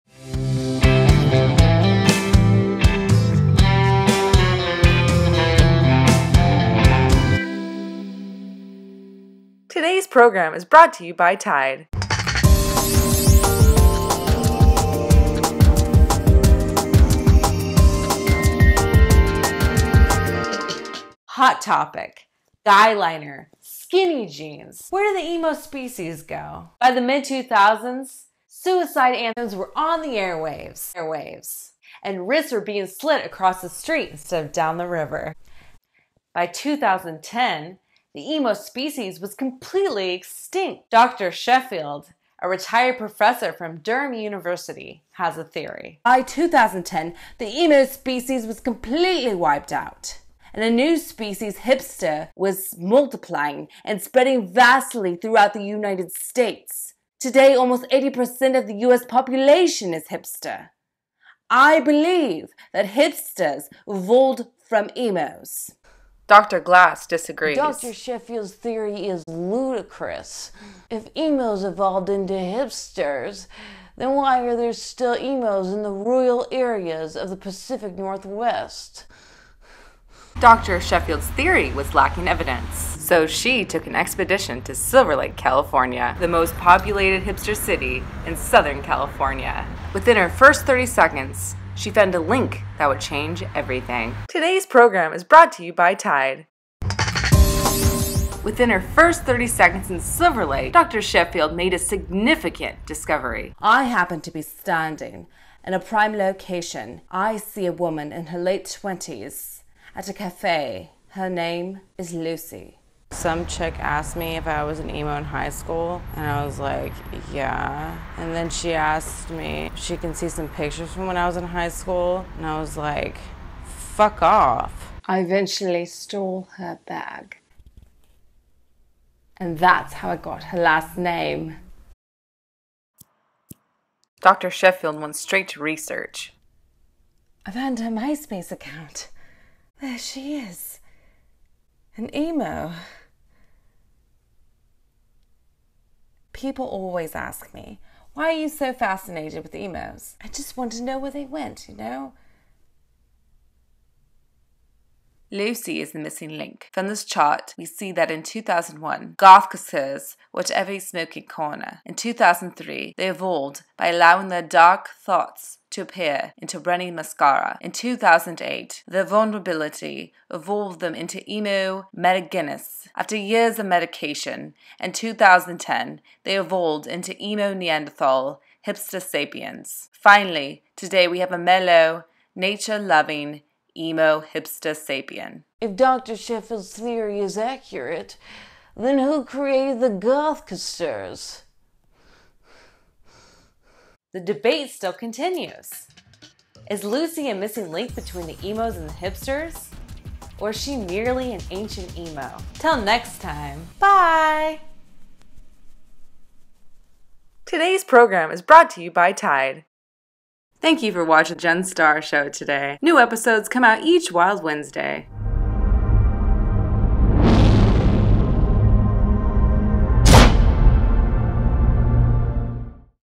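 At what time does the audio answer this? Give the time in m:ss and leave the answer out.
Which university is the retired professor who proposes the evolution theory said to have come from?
0:43.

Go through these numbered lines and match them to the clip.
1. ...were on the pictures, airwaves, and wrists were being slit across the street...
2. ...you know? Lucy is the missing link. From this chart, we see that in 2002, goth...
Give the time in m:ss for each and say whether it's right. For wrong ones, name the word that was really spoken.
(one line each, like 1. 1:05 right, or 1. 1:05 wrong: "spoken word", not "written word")
1. 0:29 wrong: "airwaves", not "pictures"
2. 2:31 wrong: "2001", not "2002".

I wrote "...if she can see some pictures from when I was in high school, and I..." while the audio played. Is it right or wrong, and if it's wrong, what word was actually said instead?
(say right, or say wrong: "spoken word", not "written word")
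right.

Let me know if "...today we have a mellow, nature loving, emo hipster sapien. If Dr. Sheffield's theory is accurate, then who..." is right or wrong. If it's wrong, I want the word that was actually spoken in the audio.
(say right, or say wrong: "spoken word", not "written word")
right.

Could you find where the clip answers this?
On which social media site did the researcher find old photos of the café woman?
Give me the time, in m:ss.
2:17.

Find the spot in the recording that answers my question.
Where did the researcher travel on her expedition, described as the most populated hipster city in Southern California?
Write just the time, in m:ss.
1:24.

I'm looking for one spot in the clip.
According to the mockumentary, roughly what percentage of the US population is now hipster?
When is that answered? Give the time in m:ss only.
0:57.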